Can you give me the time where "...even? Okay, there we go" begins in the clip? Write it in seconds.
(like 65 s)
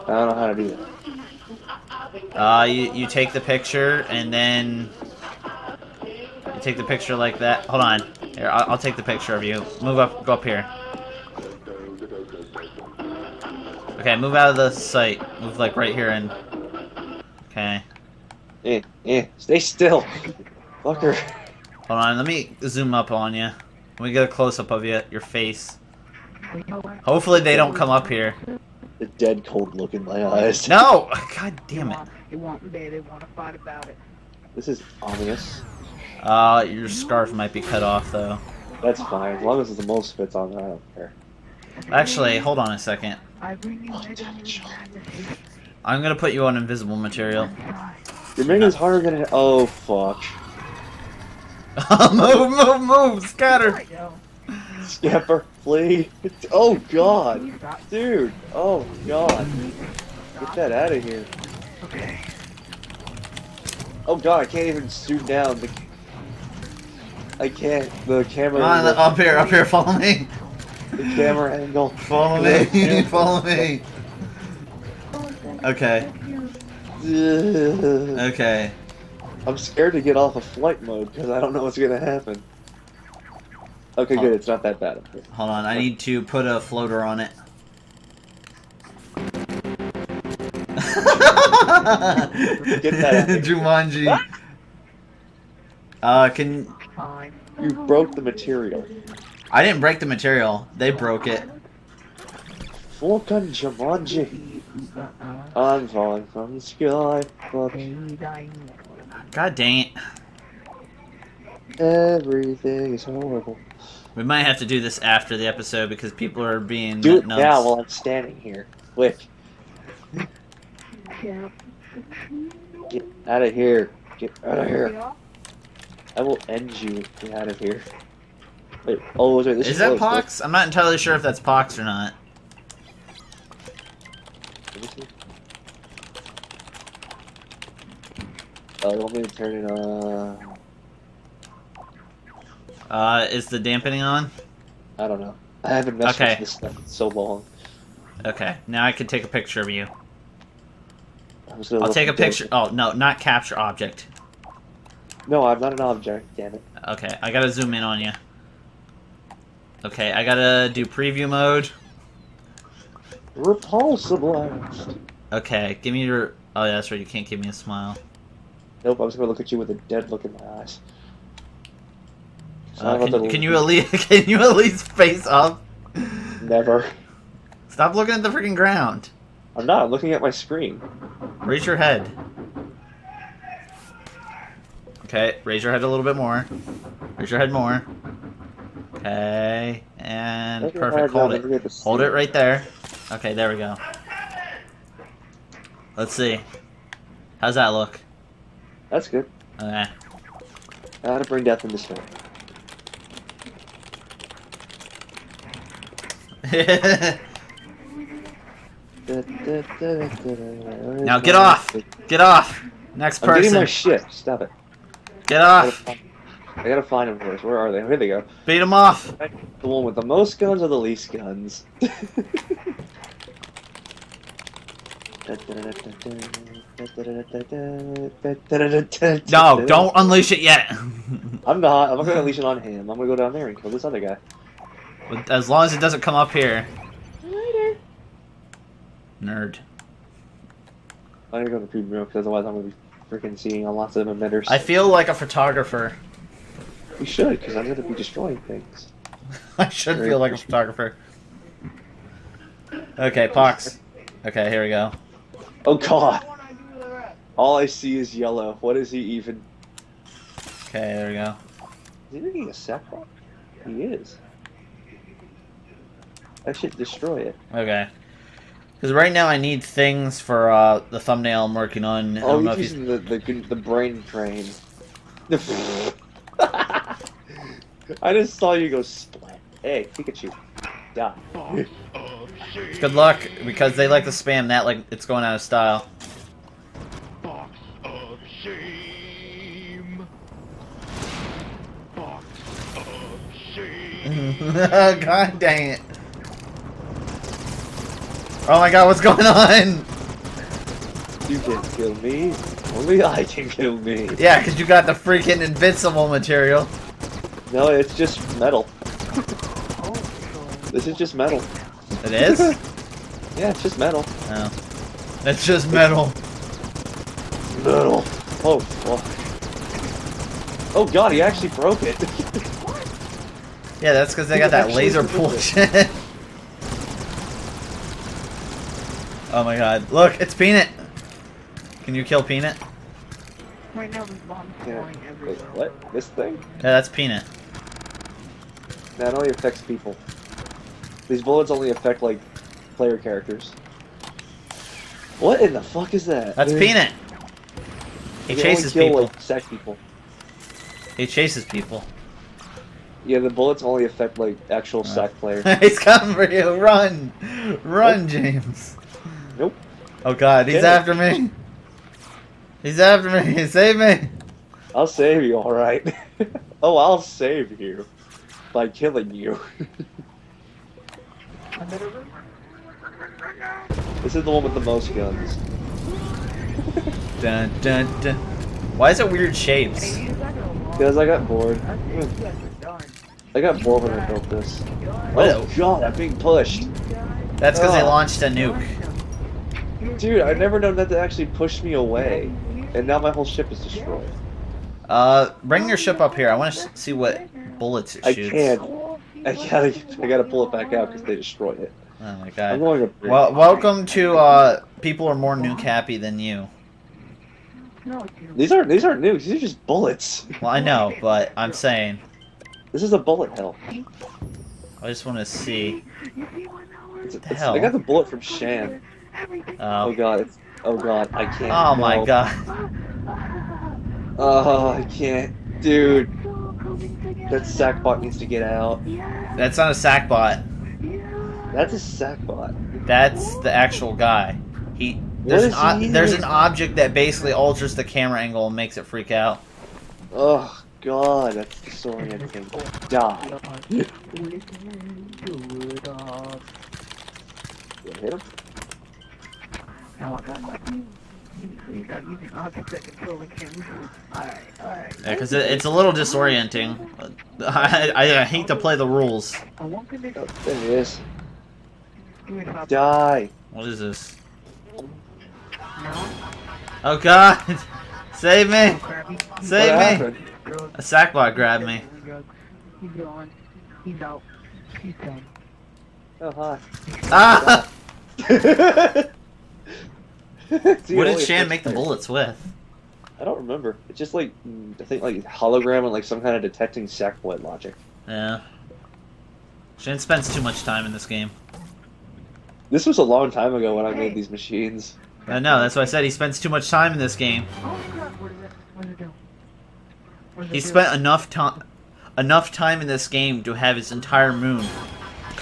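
258 s.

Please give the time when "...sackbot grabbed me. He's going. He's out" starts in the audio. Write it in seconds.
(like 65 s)
470 s.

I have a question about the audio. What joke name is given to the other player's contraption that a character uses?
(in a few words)
The brain train.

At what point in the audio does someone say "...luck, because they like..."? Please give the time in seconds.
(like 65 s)
282 s.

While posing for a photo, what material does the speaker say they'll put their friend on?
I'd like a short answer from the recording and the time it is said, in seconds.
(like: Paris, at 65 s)
Invisible material, at 46 s.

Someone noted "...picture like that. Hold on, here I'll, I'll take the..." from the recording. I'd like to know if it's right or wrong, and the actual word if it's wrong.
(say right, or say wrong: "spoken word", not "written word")
right.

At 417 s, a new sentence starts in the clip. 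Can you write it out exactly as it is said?
I got the bullet from Shan.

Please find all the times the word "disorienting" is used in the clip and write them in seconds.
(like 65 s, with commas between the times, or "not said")
441 s, 455 s.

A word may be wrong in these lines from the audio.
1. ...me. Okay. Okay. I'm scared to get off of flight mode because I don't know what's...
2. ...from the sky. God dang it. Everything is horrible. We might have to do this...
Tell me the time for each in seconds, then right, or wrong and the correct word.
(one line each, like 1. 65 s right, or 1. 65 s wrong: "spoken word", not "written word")
1. 73 s right
2. 106 s right.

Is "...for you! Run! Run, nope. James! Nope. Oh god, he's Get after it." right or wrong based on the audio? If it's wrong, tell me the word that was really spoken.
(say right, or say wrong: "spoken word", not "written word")
right.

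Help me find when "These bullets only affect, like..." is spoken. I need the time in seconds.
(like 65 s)
341 s.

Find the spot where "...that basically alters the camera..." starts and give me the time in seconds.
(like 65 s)
436 s.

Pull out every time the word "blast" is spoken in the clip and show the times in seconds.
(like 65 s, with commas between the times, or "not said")
164 s.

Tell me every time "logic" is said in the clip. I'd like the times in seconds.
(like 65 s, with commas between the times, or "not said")
487 s.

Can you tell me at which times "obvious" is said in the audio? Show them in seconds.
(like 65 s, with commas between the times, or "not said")
35 s.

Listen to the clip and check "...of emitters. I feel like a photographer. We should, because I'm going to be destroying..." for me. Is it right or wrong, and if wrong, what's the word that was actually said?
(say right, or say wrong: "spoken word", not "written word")
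right.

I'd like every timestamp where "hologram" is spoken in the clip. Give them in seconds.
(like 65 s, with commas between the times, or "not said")
485 s.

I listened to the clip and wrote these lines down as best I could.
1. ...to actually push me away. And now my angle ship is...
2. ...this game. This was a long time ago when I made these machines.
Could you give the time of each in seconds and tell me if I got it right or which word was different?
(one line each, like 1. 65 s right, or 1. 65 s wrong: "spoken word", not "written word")
1. 390 s wrong: "whole", not "angle"
2. 490 s right.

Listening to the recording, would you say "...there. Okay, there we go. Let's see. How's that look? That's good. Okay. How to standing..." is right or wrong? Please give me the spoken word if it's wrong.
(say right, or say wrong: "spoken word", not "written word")
wrong: "bring", not "standing".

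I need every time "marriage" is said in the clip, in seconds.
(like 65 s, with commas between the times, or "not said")
not said.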